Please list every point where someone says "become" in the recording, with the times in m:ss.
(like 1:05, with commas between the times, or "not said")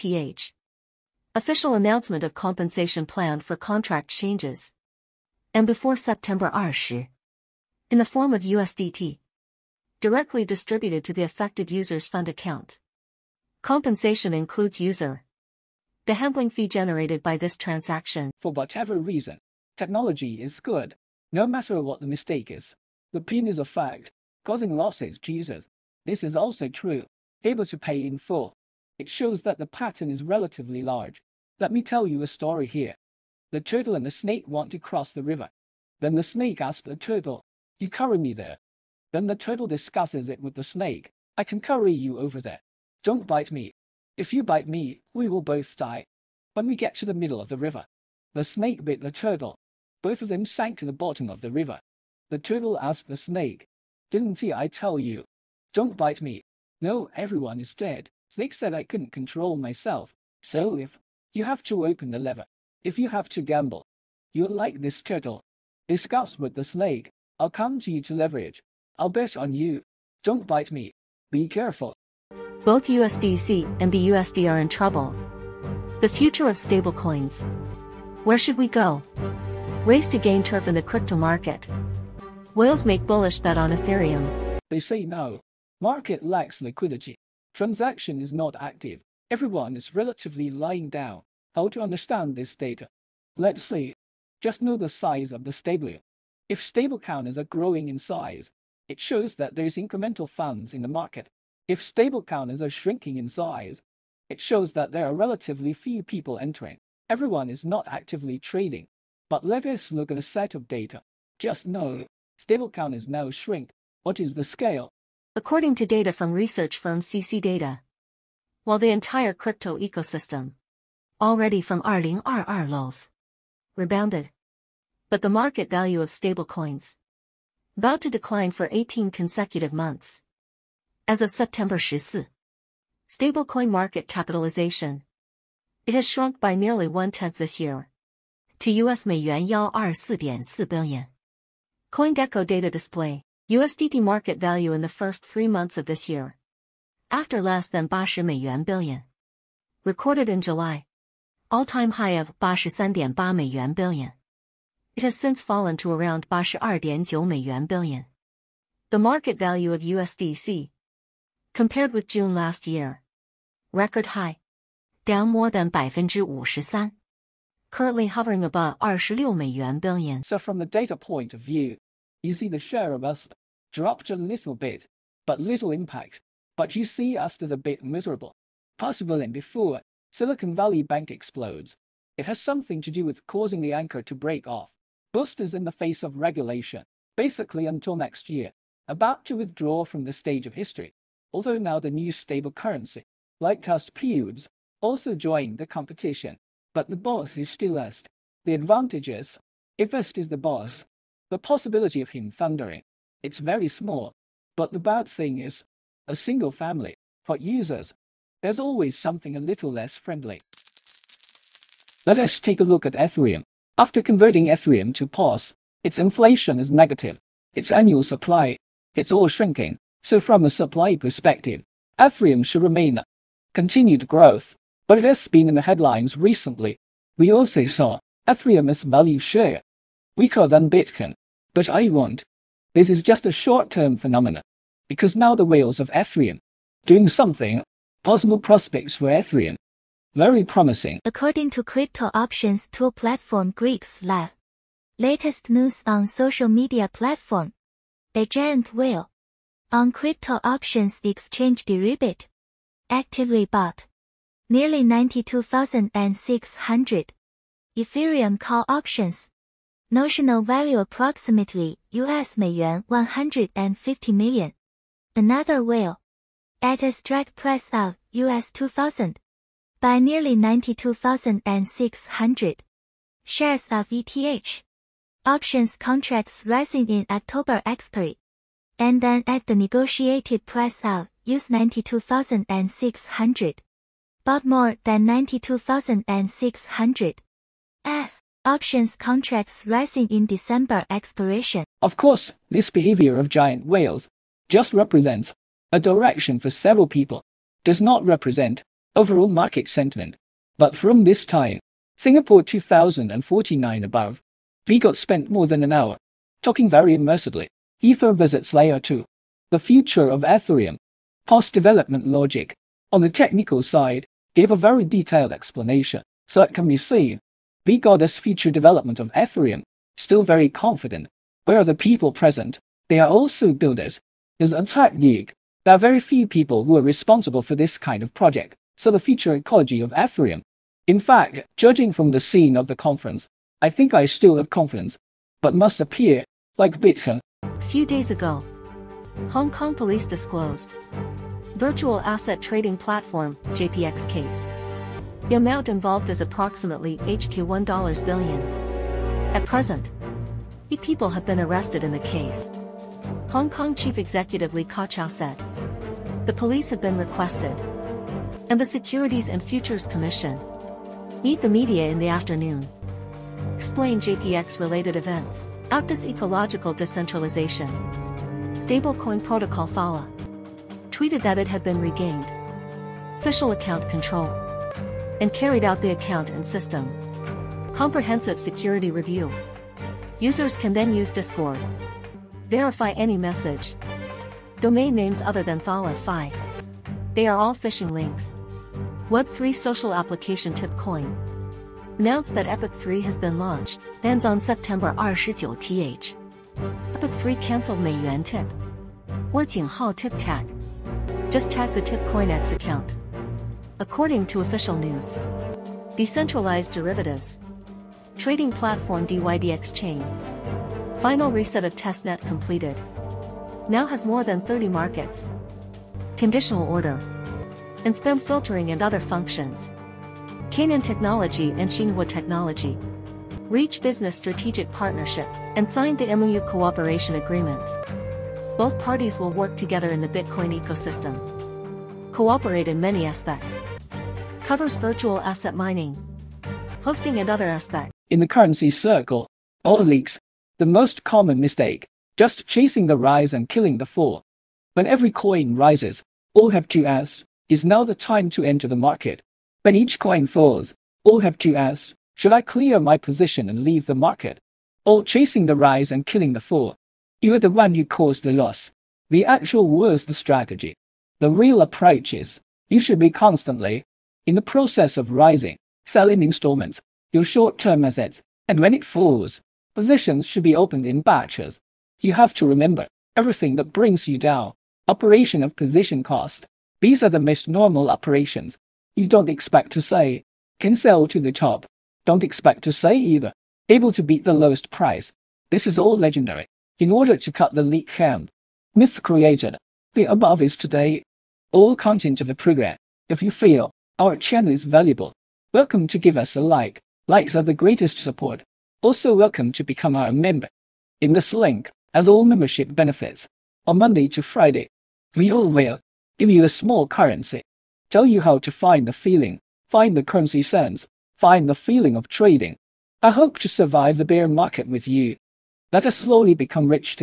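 8:19, 8:36.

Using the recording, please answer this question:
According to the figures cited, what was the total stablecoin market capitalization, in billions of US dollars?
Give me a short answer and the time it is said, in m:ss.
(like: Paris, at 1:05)
124.4 billion, at 2:19.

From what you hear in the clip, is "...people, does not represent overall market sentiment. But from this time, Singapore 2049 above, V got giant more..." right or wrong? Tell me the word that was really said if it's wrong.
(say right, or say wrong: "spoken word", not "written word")
wrong: "spent", not "giant".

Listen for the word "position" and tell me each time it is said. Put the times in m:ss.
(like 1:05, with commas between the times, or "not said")
7:32, 7:49, 7:55.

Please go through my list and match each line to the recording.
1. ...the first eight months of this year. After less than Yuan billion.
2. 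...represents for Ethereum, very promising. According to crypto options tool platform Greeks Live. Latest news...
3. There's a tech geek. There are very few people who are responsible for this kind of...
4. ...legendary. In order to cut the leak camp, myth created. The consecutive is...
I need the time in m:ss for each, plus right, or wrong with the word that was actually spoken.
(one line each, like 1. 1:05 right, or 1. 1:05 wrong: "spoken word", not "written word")
1. 2:24 wrong: "three", not "eight"
2. 3:58 wrong: "prospects", not "represents"
3. 5:24 right
4. 8:05 wrong: "above", not "consecutive".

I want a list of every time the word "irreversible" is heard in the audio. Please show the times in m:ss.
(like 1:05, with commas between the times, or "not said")
not said.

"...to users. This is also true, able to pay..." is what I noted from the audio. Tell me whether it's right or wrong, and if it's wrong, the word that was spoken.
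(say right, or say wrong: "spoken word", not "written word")
right.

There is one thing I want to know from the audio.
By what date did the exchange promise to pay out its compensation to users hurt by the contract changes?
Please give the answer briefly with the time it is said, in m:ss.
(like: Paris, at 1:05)
September 20, at 0:05.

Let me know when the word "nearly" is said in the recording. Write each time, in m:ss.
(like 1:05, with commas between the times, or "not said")
2:16, 4:14, 4:30.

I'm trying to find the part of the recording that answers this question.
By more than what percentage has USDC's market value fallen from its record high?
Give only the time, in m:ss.
2:45.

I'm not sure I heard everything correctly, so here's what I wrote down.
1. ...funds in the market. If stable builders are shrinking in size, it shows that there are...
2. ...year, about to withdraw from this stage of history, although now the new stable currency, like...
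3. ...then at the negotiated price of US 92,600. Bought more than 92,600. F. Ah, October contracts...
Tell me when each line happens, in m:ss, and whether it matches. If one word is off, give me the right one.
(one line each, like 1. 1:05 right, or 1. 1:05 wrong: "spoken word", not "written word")
1. 1:40 wrong: "counters", not "builders"
2. 3:08 right
3. 4:39 wrong: "Options", not "October".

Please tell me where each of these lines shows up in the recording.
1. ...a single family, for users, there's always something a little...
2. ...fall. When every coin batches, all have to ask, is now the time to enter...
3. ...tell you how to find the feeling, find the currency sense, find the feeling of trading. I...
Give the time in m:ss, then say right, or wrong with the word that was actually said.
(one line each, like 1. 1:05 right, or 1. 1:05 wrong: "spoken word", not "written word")
1. 3:26 right
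2. 7:23 wrong: "rises", not "batches"
3. 8:27 right.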